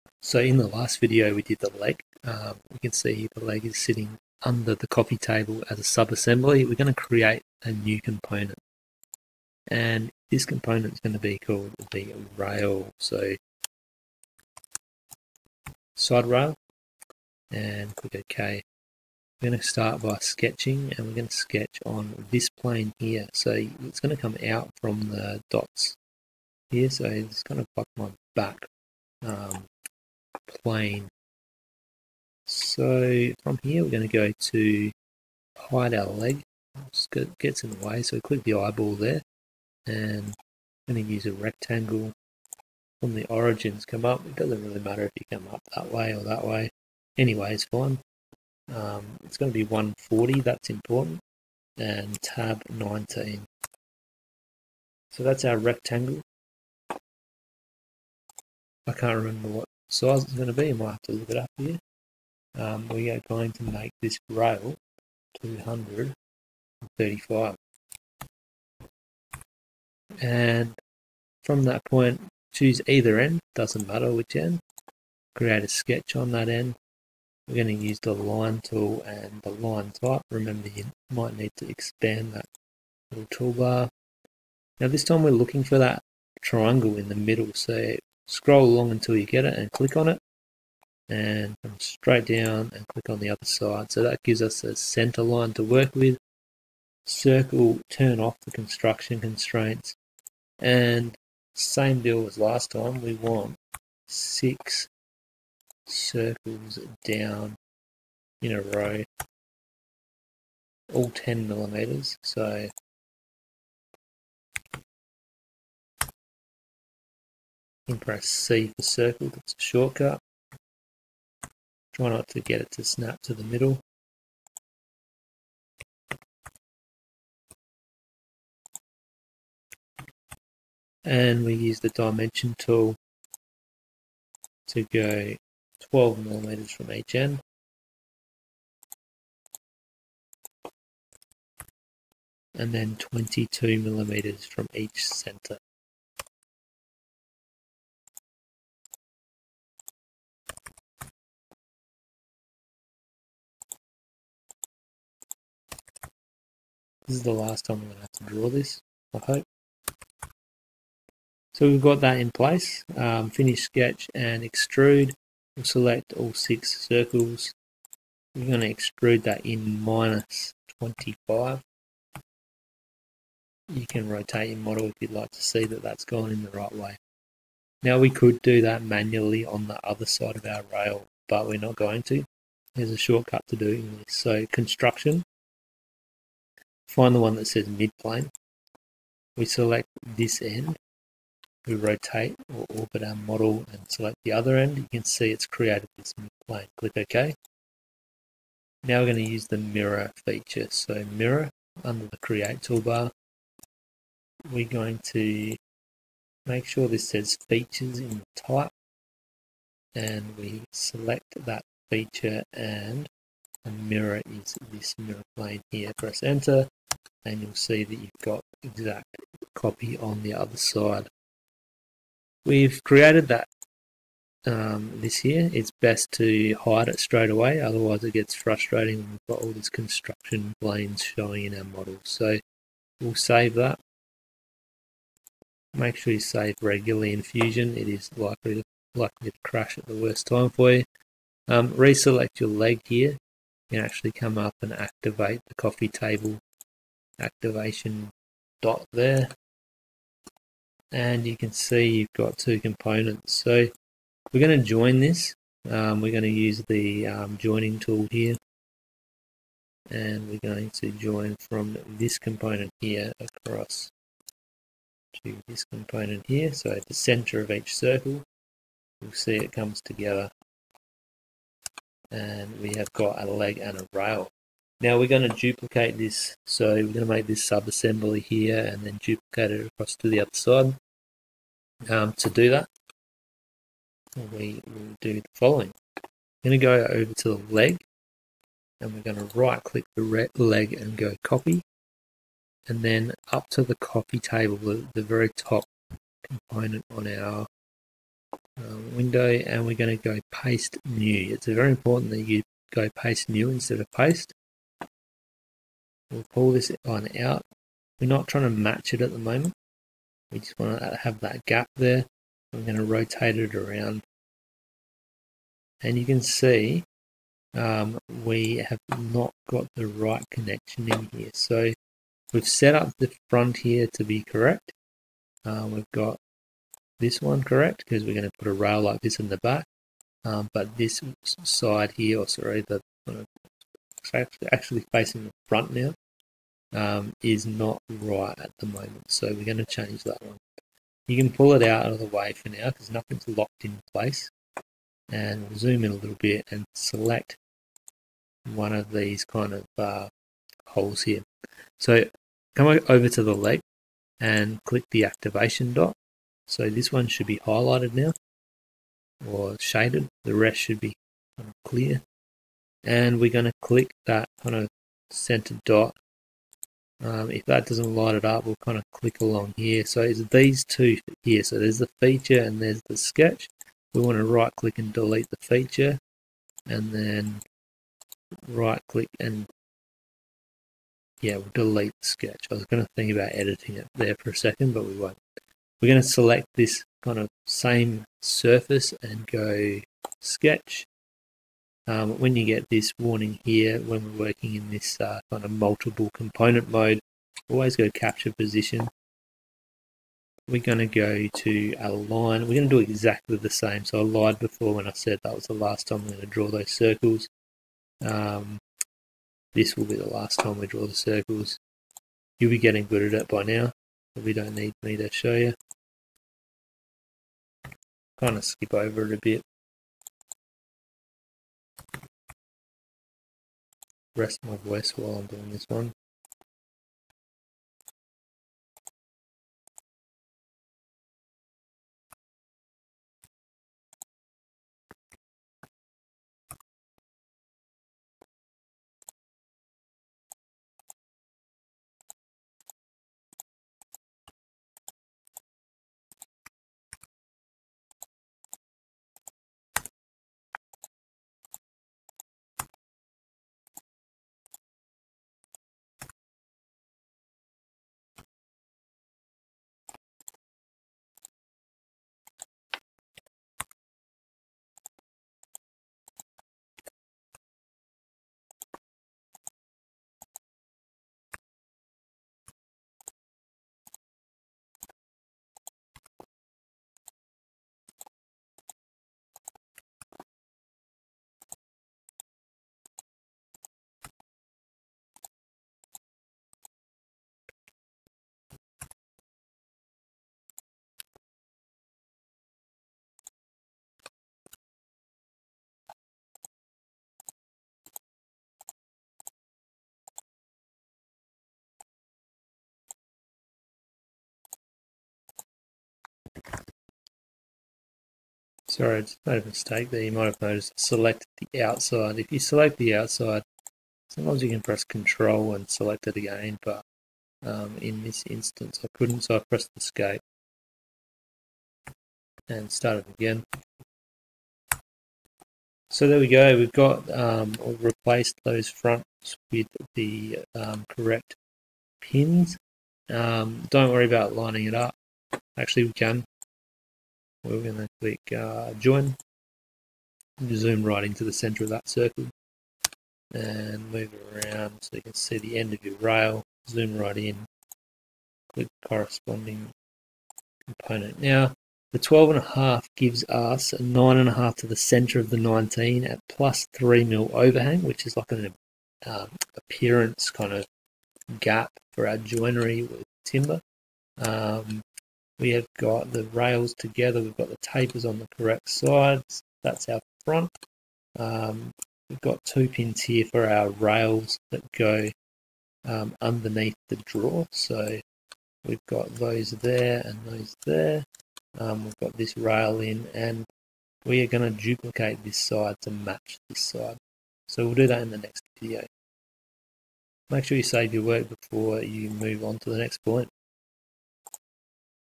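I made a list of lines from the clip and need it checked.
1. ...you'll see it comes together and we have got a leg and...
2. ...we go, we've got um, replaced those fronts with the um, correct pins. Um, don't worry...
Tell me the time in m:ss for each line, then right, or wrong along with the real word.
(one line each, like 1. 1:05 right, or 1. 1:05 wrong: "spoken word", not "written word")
1. 4:29 right
2. 8:46 right.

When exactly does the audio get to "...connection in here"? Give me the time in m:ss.
5:20.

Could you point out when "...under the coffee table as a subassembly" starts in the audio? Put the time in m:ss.
0:04.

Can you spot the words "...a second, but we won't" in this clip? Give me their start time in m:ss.
6:24.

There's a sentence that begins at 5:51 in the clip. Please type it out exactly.
So come over to the leg and click the activation dot.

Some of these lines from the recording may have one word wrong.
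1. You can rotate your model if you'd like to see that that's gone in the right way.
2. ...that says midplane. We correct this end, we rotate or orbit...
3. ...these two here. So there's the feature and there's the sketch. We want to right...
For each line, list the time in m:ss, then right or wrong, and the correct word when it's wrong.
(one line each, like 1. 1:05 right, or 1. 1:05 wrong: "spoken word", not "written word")
1. 2:53 right
2. 3:07 wrong: "select", not "correct"
3. 6:10 right.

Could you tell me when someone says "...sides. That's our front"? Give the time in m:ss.
9:28.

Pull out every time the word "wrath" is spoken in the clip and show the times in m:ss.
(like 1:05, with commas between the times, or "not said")
not said.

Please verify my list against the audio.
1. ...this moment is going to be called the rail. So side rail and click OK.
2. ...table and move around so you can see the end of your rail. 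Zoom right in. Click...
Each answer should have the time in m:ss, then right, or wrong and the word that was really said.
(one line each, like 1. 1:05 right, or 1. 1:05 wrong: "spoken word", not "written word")
1. 0:10 wrong: "component", not "moment"
2. 9:01 wrong: "circle", not "table".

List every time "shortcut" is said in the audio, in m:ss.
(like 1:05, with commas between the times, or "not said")
1:59, 3:02.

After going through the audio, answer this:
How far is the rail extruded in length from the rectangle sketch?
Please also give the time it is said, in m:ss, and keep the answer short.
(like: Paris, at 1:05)
235, at 1:05.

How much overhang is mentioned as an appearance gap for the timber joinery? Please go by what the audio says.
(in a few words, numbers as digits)
3 mm.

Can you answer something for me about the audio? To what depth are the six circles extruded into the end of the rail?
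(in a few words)
-25.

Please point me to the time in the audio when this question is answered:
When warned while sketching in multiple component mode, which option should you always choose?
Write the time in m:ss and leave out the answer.
6:37.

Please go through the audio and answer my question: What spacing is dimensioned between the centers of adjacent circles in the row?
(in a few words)
22 millimeters.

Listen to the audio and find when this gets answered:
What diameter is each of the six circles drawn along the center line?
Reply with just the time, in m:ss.
1:51.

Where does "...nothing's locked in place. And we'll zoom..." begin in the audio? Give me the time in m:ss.
5:42.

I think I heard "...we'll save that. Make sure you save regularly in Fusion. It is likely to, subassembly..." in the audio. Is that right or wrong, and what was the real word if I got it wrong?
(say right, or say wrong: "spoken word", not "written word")
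wrong: "likely", not "subassembly".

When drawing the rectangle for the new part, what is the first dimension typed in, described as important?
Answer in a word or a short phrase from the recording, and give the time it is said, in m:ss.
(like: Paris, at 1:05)
140, at 0:49.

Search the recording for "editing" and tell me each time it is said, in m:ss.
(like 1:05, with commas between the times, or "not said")
6:23.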